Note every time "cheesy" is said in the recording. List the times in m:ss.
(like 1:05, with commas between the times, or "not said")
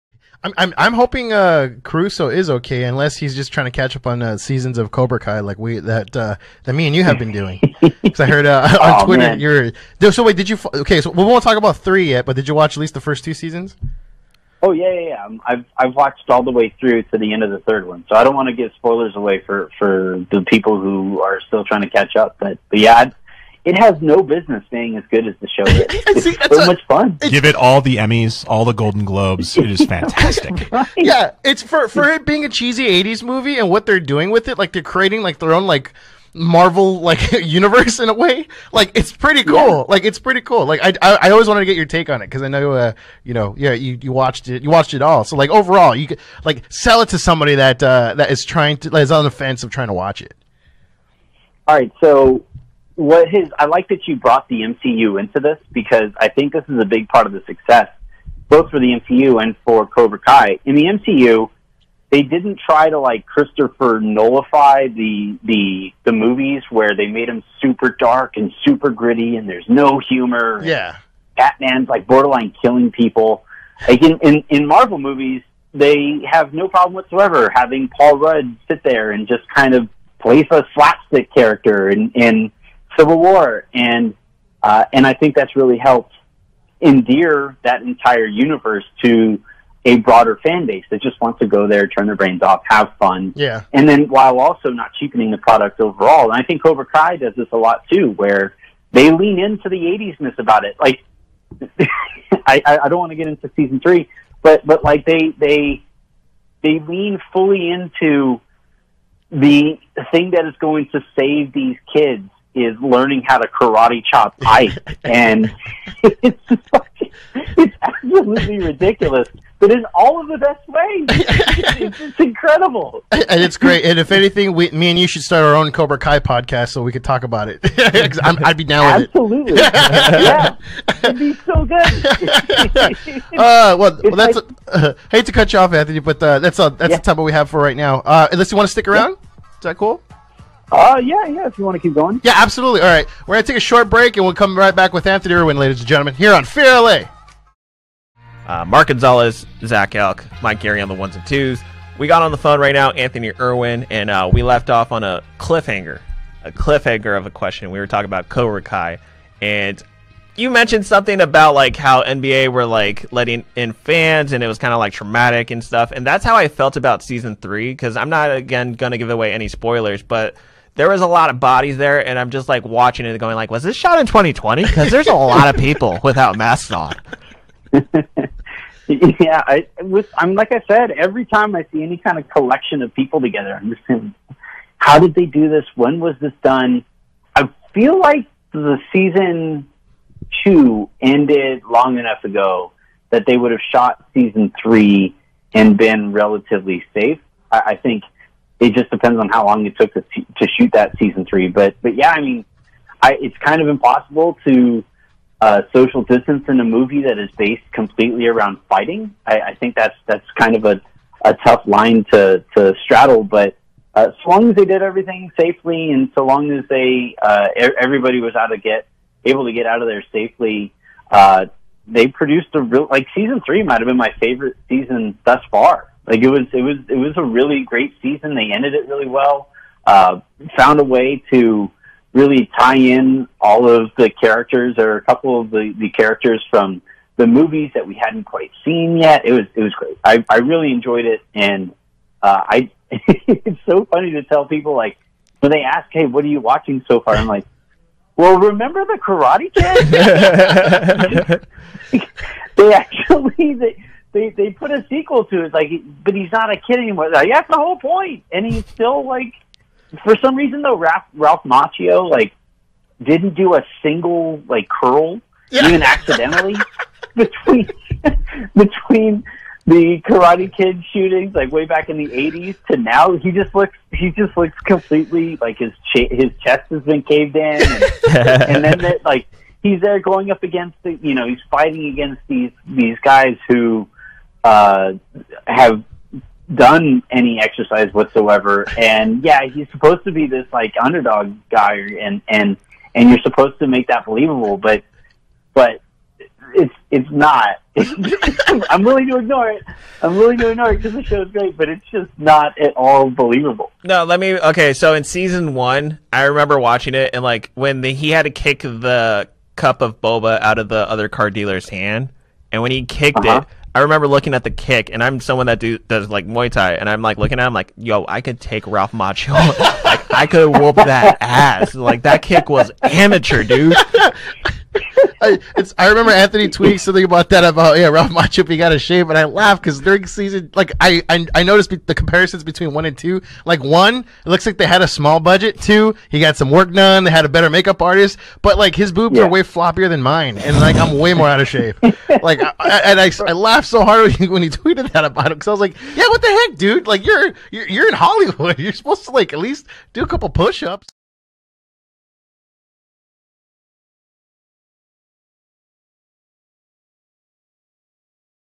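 0:32.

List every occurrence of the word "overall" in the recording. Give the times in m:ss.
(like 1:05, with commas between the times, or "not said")
0:45, 1:35.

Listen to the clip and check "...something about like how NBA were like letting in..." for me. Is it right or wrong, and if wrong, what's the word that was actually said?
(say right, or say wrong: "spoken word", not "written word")
right.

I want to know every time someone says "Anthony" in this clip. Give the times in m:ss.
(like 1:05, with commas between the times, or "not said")
2:15, 2:25, 2:32, 5:26.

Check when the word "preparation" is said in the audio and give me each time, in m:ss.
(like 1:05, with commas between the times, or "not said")
not said.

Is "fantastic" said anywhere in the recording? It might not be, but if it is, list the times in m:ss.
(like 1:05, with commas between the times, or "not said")
0:29.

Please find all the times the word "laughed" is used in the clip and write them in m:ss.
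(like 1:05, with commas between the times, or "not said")
5:29, 5:43.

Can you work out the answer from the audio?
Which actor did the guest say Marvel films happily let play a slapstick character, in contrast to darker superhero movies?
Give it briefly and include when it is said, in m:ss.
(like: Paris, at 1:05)
Paul Rudd, at 1:17.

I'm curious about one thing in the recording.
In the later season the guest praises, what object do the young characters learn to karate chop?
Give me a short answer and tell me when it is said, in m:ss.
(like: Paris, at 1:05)
Ice, at 1:54.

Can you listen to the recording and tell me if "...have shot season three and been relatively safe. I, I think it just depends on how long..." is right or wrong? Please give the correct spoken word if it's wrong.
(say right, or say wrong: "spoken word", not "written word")
right.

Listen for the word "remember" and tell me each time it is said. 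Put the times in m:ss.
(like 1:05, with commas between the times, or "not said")
4:08, 5:06, 5:13, 5:25.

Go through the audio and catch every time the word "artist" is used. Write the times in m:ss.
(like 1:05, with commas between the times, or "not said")
5:37.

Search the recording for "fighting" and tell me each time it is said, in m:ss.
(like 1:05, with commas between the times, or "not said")
3:28, 4:41.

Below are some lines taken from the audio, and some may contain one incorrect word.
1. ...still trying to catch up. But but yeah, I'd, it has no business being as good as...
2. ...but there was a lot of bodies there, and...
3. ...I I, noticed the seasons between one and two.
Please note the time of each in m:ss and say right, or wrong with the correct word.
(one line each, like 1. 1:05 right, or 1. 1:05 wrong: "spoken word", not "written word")
1. 0:21 right
2. 2:50 right
3. 5:31 wrong: "comparisons", not "seasons".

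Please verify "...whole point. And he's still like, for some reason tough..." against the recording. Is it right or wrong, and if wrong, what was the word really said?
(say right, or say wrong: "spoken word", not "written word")
wrong: "though", not "tough".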